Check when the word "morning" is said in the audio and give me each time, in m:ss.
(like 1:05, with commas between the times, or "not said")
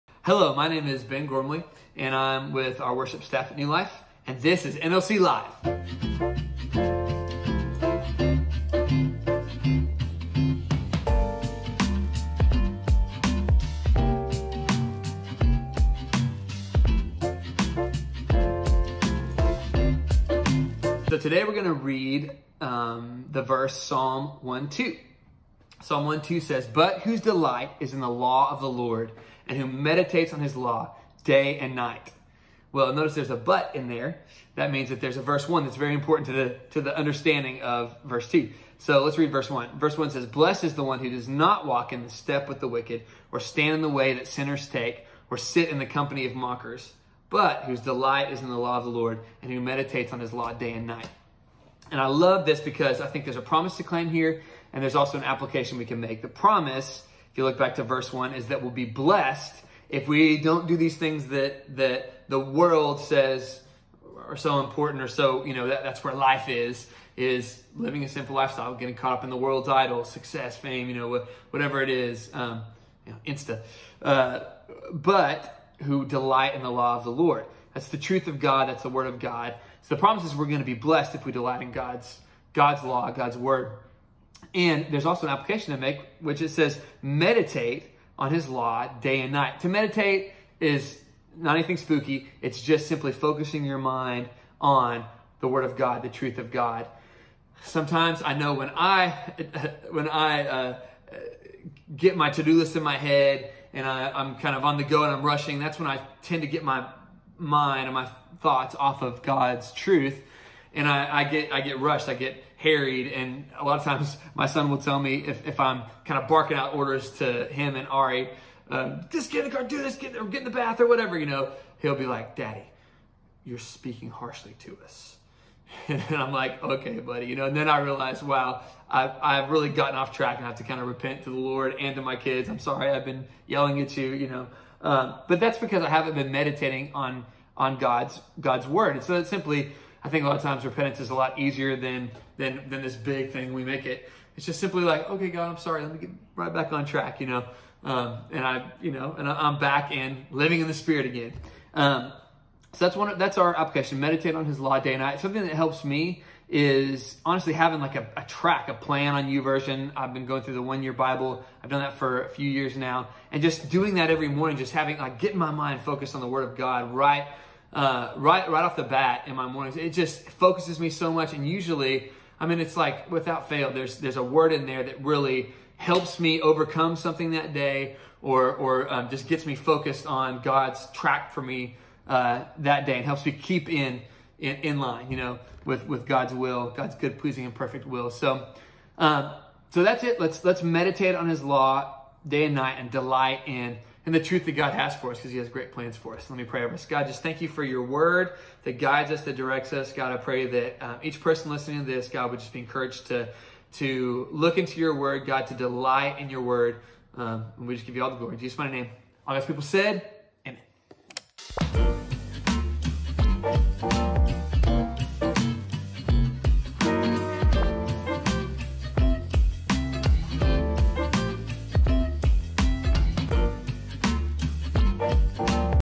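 2:44, 2:49.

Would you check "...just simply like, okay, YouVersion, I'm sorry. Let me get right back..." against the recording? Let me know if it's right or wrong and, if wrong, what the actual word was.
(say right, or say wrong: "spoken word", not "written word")
wrong: "God", not "YouVersion".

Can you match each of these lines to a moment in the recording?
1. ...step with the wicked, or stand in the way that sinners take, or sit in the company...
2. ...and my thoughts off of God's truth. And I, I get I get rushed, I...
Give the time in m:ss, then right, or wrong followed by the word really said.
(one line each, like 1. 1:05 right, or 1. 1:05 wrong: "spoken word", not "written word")
1. 0:42 right
2. 1:47 right.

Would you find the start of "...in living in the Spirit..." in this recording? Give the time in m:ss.
2:29.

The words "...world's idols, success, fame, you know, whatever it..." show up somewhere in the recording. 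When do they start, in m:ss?
1:09.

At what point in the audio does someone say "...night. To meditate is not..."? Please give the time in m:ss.
1:29.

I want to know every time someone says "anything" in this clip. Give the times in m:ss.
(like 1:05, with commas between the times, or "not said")
1:31.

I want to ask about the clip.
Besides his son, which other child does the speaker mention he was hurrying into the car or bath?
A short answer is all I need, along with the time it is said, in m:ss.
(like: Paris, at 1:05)
Ari, at 1:57.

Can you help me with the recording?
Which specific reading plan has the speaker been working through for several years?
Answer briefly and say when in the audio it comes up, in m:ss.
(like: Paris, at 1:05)
One year Bible, at 2:40.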